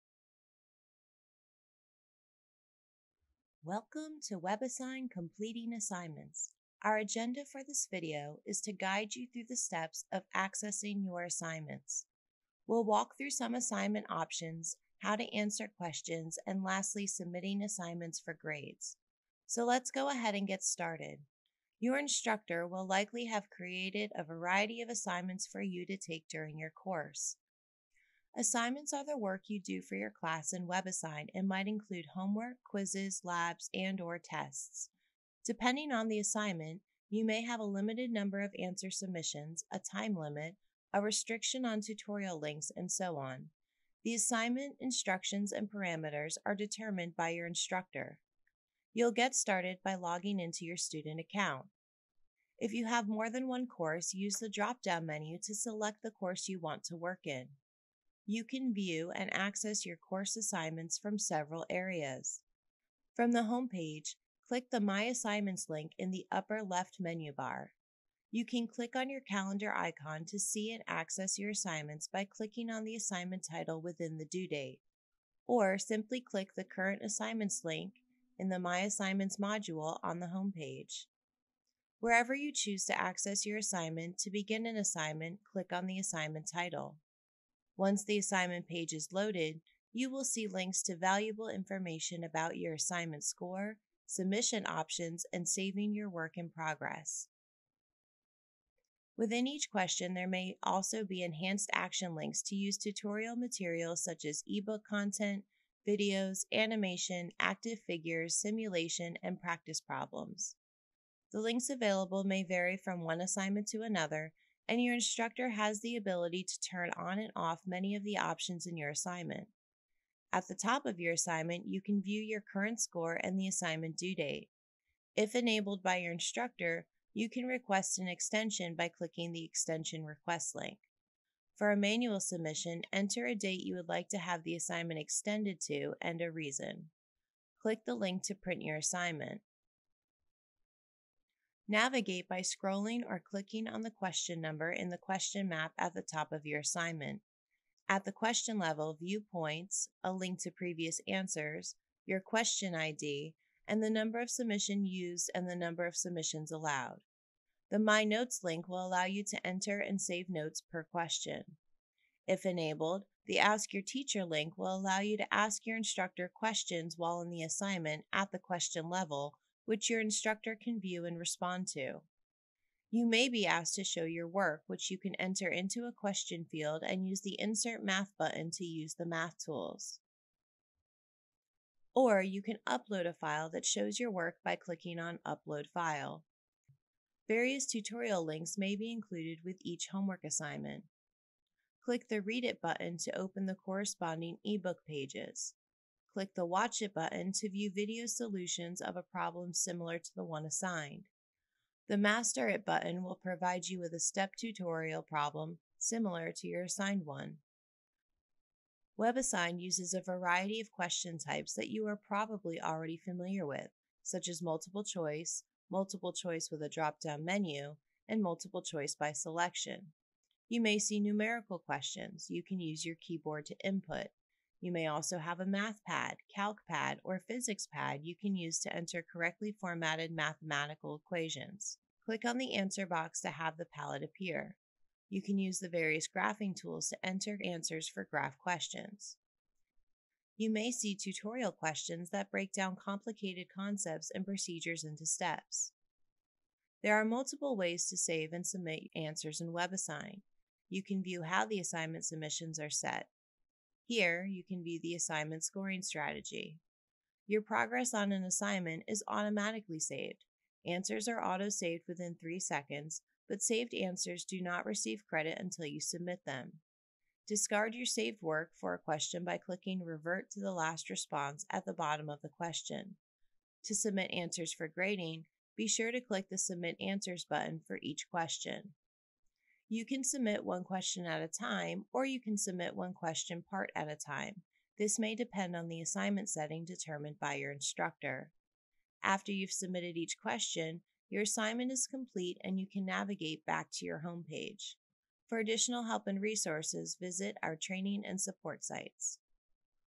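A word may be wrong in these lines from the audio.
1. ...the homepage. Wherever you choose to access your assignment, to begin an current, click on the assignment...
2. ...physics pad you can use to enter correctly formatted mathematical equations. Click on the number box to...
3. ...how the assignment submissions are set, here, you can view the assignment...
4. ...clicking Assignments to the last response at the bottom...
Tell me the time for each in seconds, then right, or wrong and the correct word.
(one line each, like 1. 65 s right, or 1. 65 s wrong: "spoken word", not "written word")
1. 80 s wrong: "assignment", not "current"
2. 227 s wrong: "answer", not "number"
3. 251 s right
4. 269 s wrong: "Revert", not "Assignments".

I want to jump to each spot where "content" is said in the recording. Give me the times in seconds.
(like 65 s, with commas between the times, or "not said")
104 s.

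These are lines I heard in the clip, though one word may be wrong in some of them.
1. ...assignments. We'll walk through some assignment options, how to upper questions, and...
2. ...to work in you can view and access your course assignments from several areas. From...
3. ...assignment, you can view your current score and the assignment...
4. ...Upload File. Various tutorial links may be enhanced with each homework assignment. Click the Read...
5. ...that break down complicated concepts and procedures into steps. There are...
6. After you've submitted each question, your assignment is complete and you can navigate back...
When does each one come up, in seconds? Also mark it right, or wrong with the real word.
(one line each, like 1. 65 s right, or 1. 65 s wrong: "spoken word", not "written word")
1. 11 s wrong: "answer", not "upper"
2. 56 s right
3. 121 s right
4. 185 s wrong: "included", not "enhanced"
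5. 242 s right
6. 289 s right.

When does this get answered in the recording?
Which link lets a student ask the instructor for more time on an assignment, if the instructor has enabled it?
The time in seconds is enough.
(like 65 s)
129 s.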